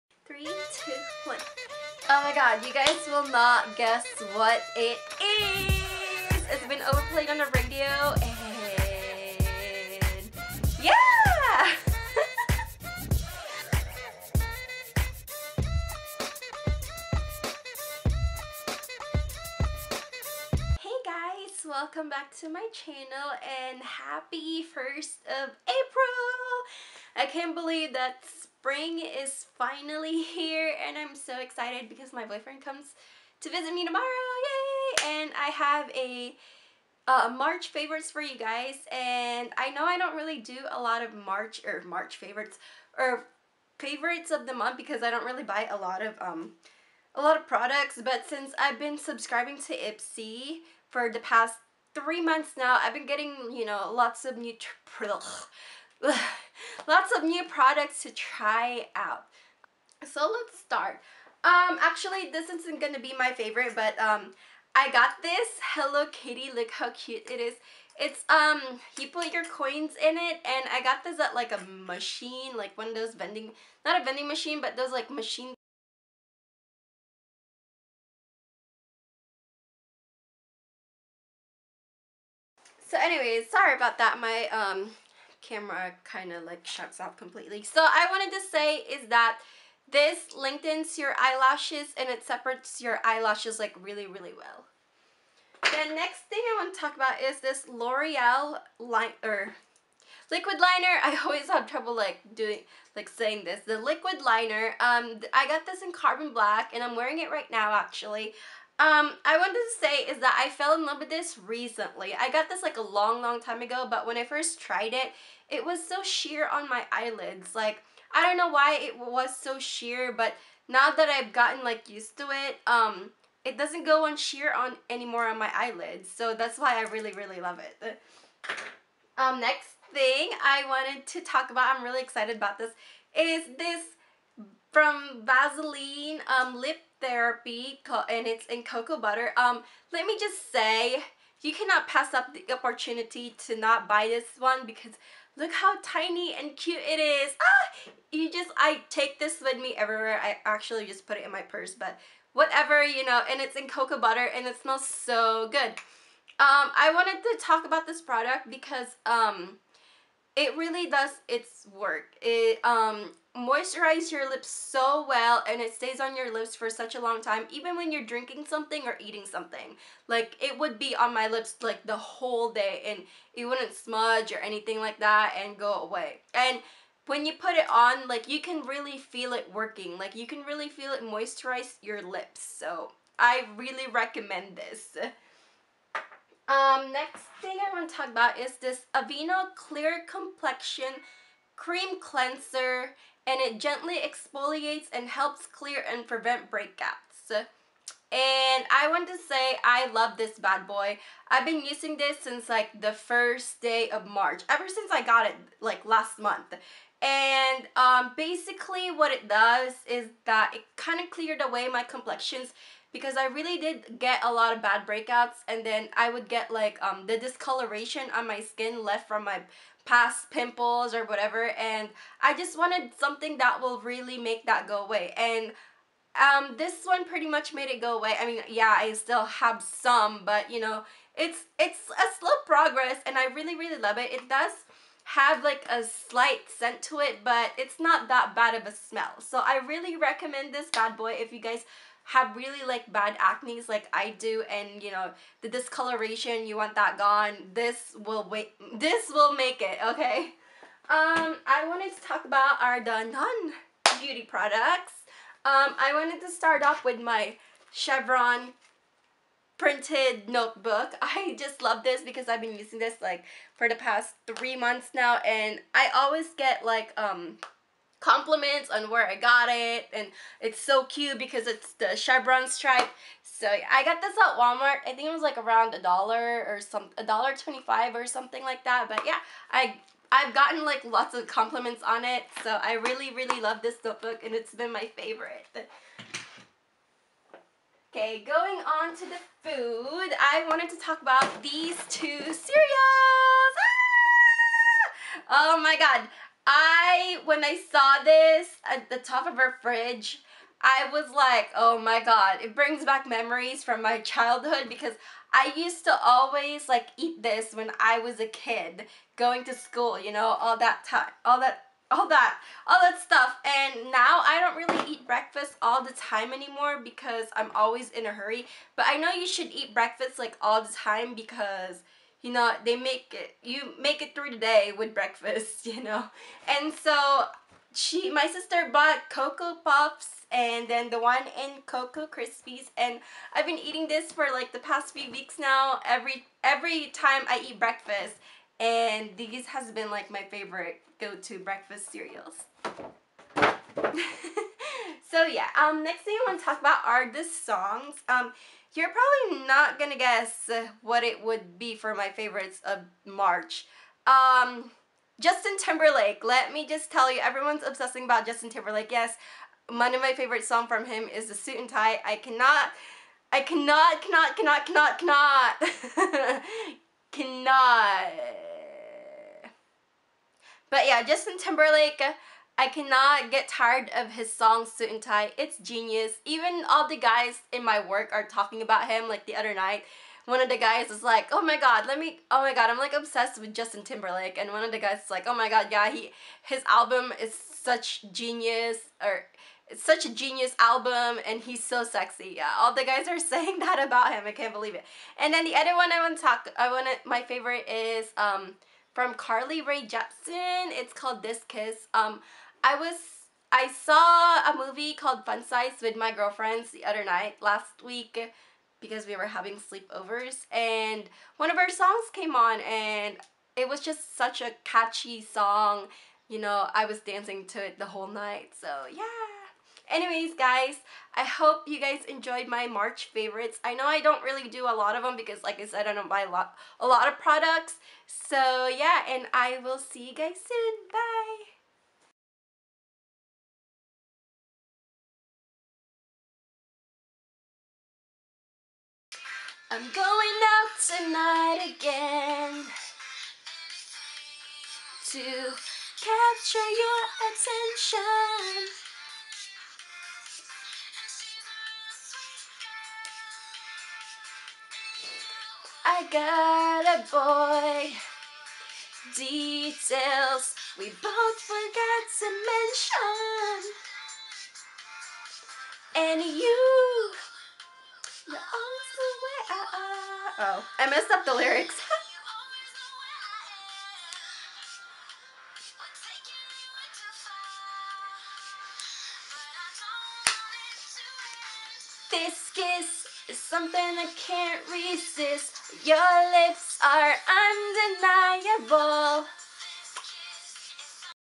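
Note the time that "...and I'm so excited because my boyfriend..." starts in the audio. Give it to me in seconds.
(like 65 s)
30 s.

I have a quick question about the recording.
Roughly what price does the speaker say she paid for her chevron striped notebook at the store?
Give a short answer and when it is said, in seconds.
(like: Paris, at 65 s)
$1.25, at 276 s.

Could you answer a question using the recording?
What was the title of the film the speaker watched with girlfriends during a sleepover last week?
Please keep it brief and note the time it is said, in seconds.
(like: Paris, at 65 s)
Fun Size, at 405 s.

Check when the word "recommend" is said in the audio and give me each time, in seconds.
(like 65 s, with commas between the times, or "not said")
183 s, 239 s.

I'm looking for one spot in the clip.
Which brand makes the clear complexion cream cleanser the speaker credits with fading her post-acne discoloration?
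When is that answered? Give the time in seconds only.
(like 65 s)
188 s.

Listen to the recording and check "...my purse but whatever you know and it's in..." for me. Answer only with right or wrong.
right.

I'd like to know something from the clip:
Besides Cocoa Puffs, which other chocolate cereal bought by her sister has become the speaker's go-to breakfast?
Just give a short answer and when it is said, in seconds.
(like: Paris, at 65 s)
Cocoa Krispies, at 331 s.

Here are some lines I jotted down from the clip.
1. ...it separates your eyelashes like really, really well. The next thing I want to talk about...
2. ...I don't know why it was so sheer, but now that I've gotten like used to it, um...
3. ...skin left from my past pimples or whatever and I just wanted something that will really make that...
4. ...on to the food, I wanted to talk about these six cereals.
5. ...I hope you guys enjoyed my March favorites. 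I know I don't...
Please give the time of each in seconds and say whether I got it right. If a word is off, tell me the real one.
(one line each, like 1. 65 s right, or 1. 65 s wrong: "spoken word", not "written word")
1. 92 s right
2. 118 s right
3. 218 s right
4. 288 s wrong: "two", not "six"
5. 421 s right.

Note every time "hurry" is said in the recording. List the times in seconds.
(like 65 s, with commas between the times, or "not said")
318 s.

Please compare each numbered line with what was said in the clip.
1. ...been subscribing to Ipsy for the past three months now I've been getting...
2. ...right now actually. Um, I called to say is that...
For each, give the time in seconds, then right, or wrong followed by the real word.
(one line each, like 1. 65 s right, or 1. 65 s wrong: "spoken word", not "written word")
1. 48 s right
2. 107 s wrong: "wanted", not "called".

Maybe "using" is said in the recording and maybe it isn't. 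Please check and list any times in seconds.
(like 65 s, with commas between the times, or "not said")
201 s, 262 s.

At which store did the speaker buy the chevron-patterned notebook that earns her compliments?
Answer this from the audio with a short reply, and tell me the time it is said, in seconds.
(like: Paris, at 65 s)
Walmart, at 274 s.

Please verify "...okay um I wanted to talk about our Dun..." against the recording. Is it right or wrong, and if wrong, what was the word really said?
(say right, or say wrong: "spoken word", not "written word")
right.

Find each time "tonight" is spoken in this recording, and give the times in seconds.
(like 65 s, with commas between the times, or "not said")
440 s.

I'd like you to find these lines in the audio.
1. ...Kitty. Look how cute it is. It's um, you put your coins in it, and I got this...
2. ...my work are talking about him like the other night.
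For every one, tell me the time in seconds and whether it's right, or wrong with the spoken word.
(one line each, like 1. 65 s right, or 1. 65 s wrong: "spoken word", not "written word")
1. 66 s right
2. 377 s right.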